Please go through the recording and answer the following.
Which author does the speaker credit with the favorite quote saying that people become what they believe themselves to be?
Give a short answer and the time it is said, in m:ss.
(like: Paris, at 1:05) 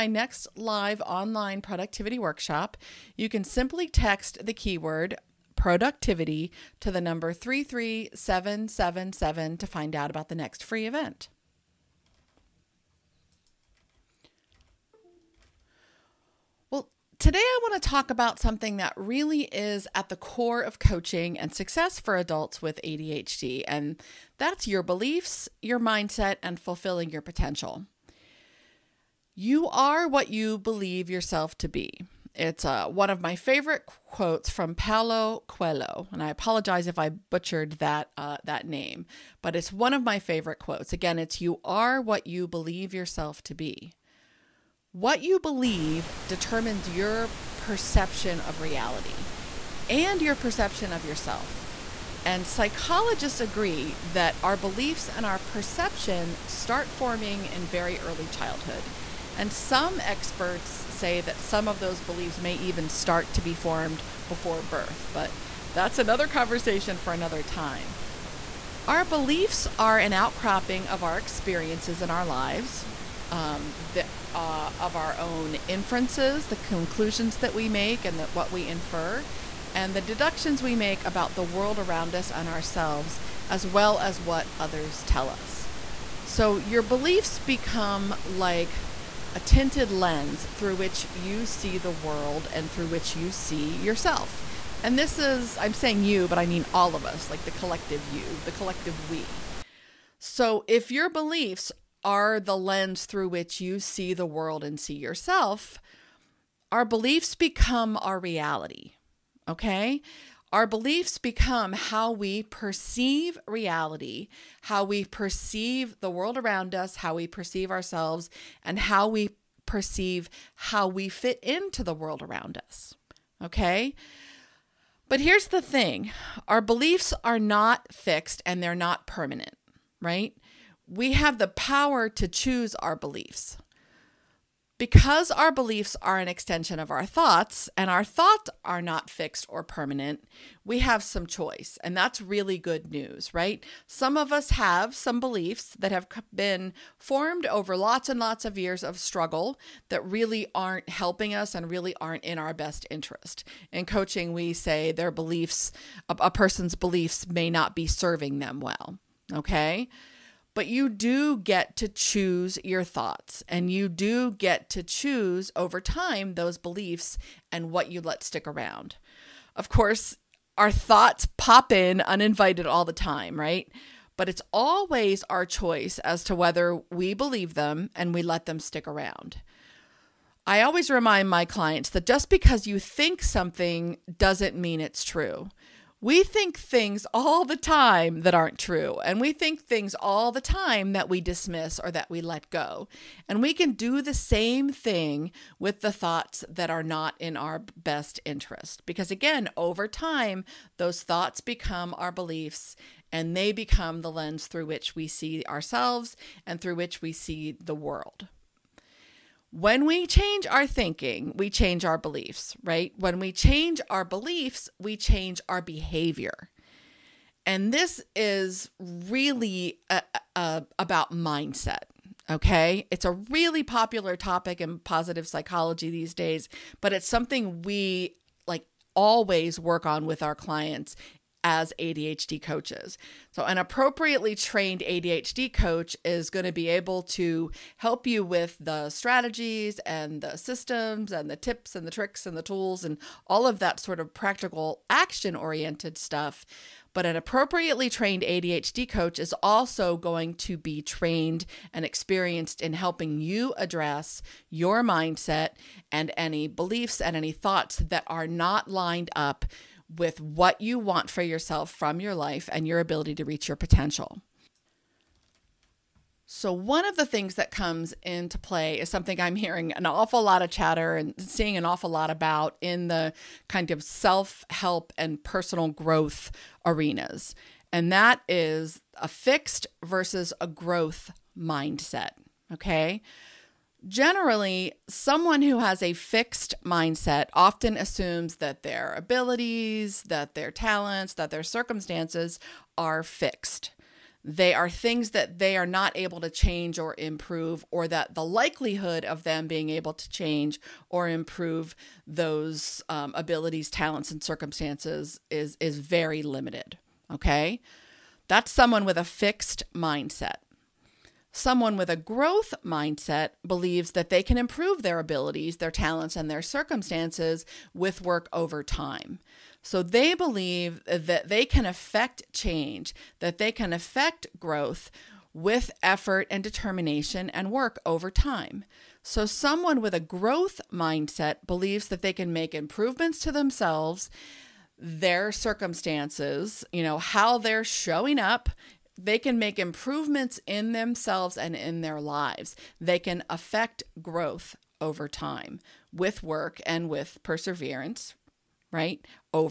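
Paulo Coelho, at 0:34.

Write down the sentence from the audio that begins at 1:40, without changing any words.
So if your beliefs are the lens through which you see the world and see yourself, our beliefs become our reality Okay.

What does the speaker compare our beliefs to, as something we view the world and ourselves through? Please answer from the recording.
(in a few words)
tinted lens.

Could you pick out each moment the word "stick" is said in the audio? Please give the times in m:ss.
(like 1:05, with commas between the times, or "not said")
2:48, 2:58.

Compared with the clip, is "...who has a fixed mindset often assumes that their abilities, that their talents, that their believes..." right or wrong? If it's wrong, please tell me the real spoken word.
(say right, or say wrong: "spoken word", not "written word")
wrong: "circumstances", not "believes".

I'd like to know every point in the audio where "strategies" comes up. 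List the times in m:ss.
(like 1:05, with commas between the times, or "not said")
3:58.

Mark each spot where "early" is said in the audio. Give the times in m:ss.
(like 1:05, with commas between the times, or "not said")
0:58.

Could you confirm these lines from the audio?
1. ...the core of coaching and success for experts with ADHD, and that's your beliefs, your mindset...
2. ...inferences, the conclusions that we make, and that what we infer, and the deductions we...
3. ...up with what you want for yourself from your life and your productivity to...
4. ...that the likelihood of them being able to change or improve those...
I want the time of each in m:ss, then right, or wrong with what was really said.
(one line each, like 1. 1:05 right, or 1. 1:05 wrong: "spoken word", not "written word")
1. 0:20 wrong: "adults", not "experts"
2. 1:15 right
3. 4:19 wrong: "ability", not "productivity"
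4. 4:57 right.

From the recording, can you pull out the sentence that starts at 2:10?
We have the power to choose our beliefs.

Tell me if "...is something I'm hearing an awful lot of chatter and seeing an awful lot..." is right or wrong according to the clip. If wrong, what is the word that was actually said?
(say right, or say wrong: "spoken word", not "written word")
right.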